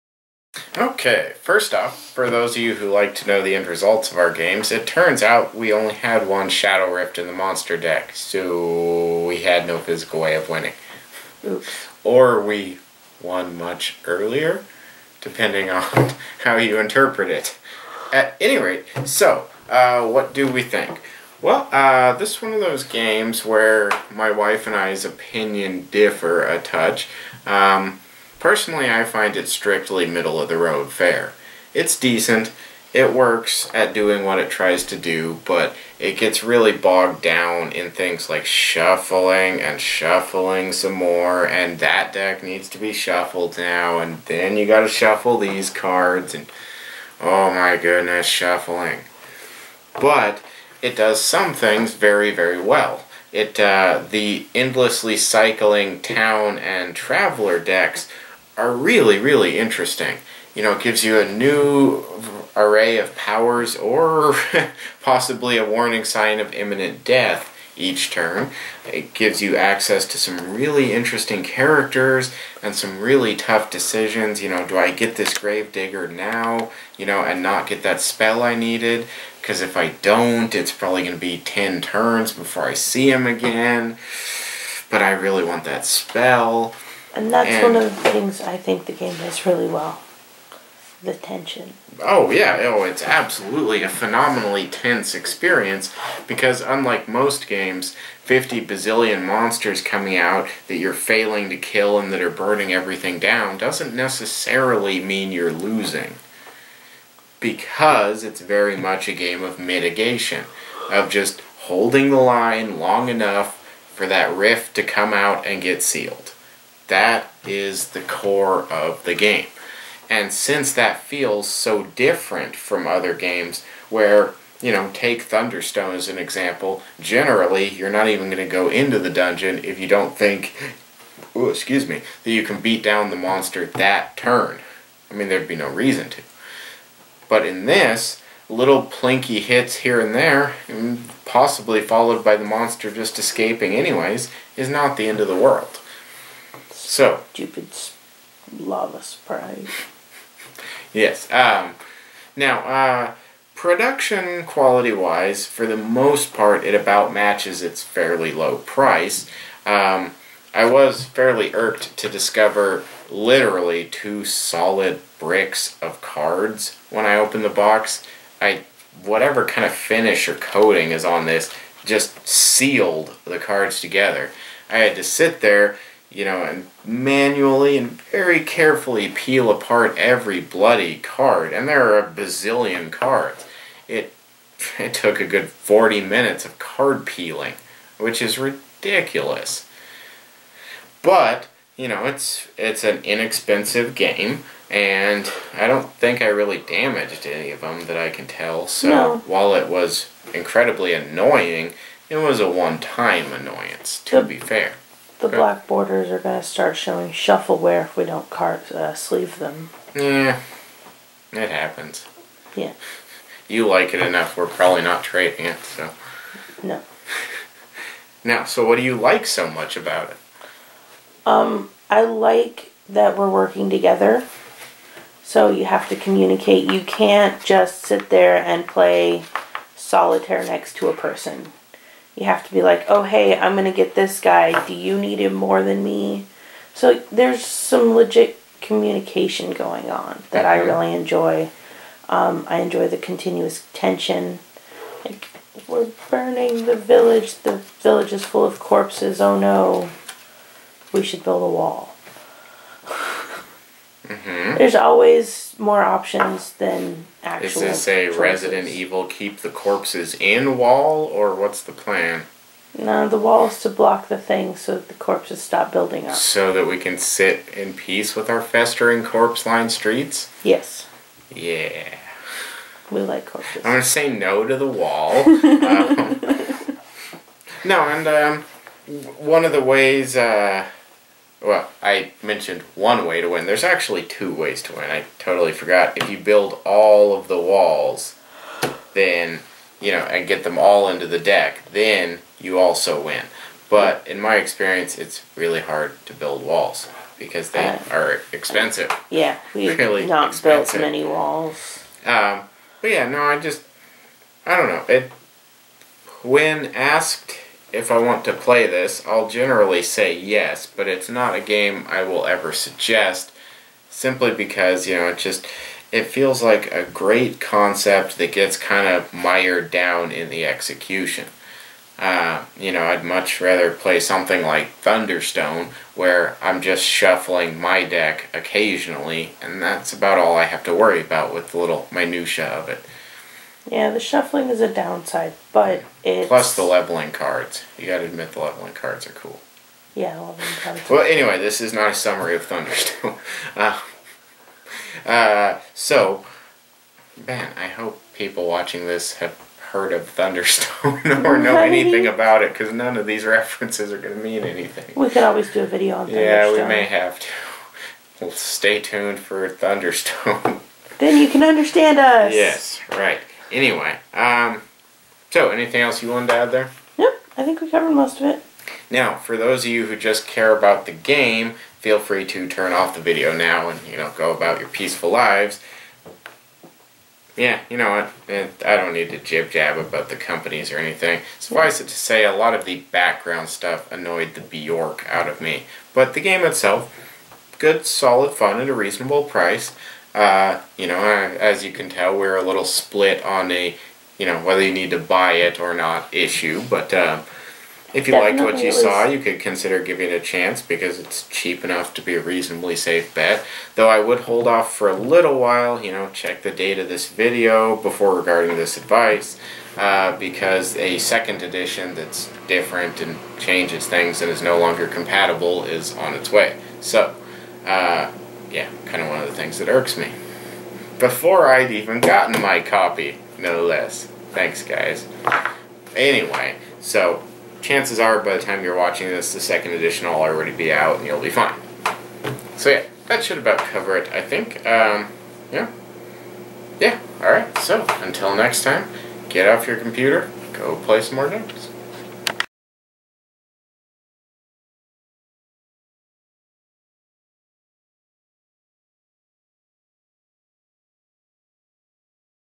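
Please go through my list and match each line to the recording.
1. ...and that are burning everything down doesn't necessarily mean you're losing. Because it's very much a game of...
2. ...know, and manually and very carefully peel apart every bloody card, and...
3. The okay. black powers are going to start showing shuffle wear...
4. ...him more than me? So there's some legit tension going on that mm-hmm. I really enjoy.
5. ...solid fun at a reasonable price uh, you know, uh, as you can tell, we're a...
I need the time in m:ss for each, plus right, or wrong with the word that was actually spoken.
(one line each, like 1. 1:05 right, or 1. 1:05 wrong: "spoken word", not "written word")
1. 1:41 right
2. 2:56 right
3. 3:25 wrong: "borders", not "powers"
4. 3:55 wrong: "communication", not "tension"
5. 6:27 right.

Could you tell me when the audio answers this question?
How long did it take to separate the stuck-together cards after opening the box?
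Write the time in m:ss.
3:05.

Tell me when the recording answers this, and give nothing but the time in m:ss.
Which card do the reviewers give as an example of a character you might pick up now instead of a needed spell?
1:15.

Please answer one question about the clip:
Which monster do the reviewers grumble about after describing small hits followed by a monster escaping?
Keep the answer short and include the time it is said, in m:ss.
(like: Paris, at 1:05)
Lava sprite, at 2:28.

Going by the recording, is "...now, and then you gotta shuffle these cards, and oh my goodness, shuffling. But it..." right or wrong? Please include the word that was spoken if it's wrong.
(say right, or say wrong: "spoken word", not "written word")
right.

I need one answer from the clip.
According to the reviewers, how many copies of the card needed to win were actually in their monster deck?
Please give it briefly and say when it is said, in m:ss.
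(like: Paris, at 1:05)
1, at 0:06.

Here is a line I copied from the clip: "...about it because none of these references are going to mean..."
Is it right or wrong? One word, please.
right.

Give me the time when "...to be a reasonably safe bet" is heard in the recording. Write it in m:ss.
6:41.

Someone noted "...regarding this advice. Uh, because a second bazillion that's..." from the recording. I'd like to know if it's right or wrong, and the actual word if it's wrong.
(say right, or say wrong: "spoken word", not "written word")
wrong: "edition", not "bazillion".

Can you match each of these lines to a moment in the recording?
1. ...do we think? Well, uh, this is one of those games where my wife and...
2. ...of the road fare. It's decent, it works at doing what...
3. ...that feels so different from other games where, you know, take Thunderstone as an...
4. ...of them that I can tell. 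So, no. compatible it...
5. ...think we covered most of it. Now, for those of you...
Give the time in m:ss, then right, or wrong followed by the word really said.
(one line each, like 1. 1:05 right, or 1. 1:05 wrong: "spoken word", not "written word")
1. 0:20 right
2. 0:30 right
3. 2:00 right
4. 3:17 wrong: "while", not "compatible"
5. 6:07 right.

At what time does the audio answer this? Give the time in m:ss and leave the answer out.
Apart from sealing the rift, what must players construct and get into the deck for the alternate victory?
4:46.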